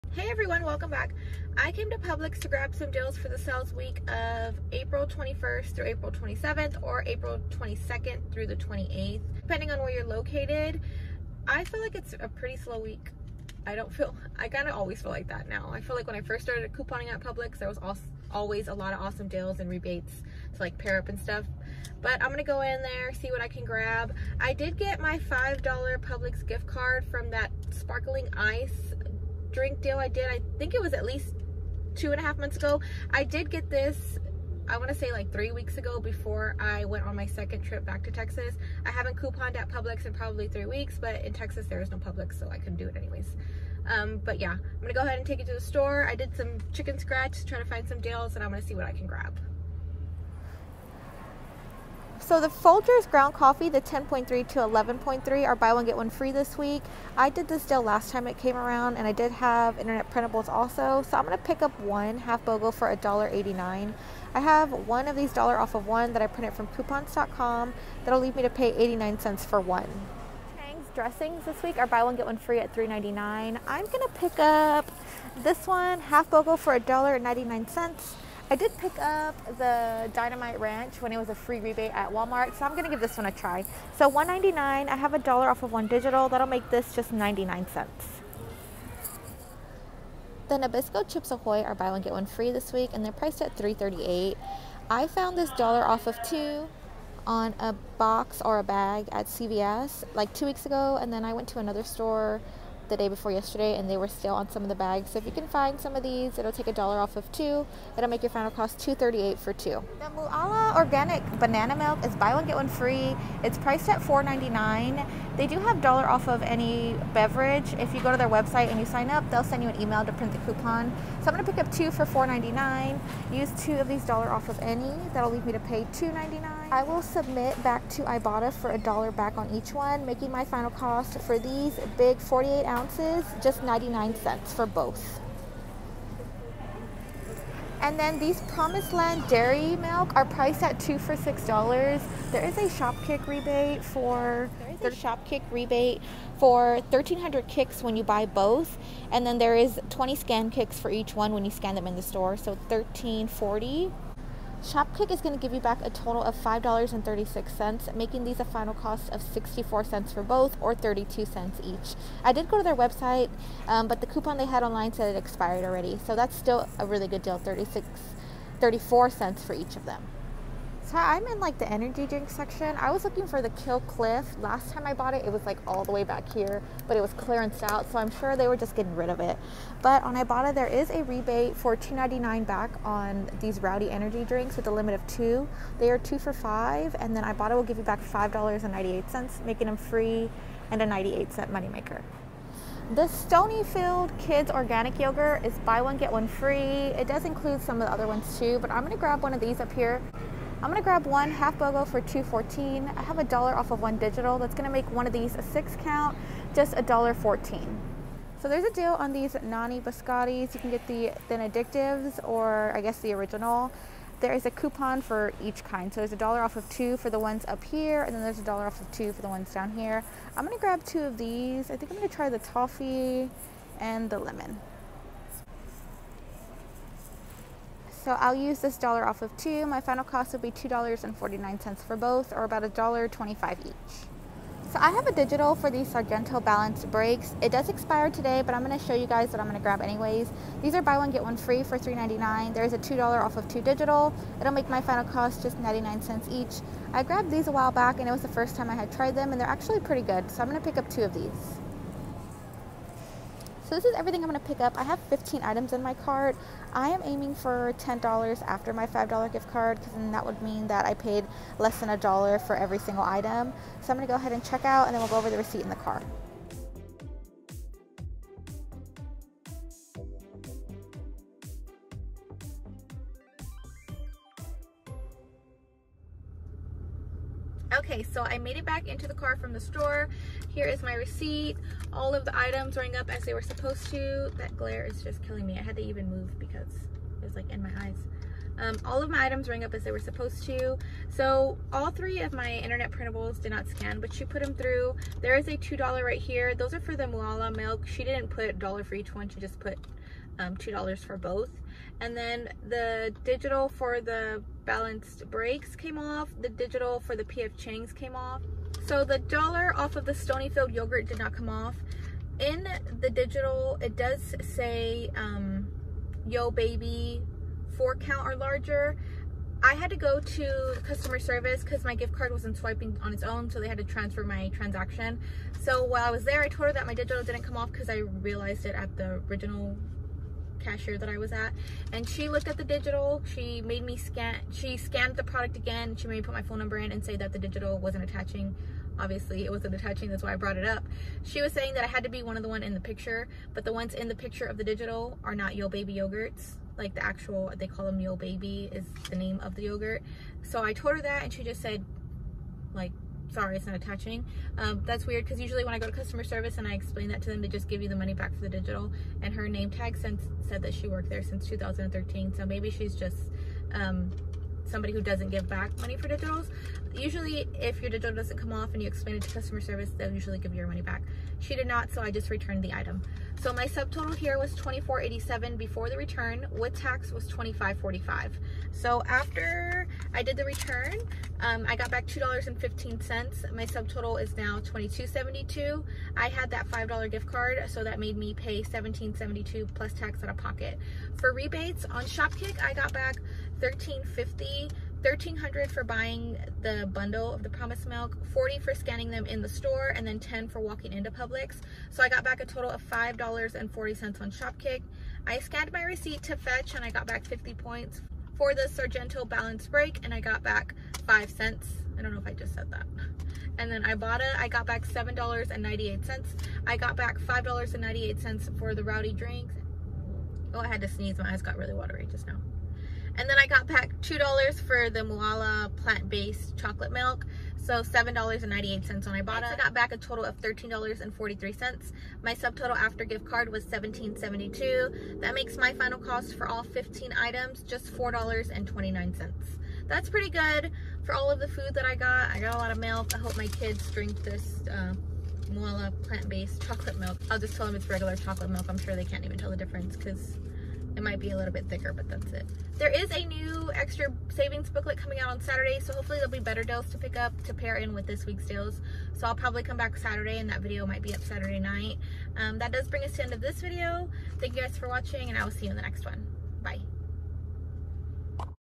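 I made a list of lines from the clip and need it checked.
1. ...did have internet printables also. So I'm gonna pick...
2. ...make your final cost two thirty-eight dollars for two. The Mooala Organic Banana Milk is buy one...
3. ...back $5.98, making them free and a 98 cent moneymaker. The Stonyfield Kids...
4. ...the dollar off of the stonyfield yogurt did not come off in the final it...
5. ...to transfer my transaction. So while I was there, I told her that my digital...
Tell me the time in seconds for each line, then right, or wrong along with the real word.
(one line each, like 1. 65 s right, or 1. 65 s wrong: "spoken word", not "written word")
1. 59 s right
2. 108 s right
3. 187 s right
4. 309 s wrong: "digital", not "final"
5. 323 s right.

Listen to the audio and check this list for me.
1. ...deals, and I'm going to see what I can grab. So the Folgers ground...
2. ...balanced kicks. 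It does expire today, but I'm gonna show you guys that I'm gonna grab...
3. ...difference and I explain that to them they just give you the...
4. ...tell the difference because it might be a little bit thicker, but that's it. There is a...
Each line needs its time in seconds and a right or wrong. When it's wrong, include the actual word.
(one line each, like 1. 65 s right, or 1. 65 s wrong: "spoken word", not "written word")
1. 47 s right
2. 236 s wrong: "breaks", not "kicks"
3. 356 s wrong: "service", not "difference"
4. 449 s right.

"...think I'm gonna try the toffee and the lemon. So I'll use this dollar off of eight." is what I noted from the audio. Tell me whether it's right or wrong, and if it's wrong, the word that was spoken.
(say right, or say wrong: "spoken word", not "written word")
wrong: "two", not "eight".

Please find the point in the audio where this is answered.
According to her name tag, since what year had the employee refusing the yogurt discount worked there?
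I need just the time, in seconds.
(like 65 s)
361 s.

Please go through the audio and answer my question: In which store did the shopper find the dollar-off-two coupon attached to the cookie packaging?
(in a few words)
CVS.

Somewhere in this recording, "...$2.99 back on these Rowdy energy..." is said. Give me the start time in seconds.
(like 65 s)
181 s.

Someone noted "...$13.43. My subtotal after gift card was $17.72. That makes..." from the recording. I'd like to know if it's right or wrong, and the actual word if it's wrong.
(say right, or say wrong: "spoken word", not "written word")
right.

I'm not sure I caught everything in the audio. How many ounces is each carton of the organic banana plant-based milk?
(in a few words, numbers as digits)
48.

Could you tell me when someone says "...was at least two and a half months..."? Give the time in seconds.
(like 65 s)
30 s.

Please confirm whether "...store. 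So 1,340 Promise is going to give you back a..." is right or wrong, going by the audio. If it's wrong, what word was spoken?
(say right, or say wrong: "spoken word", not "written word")
wrong: "Shopkick", not "Promise".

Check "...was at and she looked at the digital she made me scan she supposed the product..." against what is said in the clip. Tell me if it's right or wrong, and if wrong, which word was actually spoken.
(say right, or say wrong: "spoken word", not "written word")
wrong: "scanned", not "supposed".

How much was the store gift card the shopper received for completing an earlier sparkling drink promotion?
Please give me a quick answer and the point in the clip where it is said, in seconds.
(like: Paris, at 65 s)
$5, at 25 s.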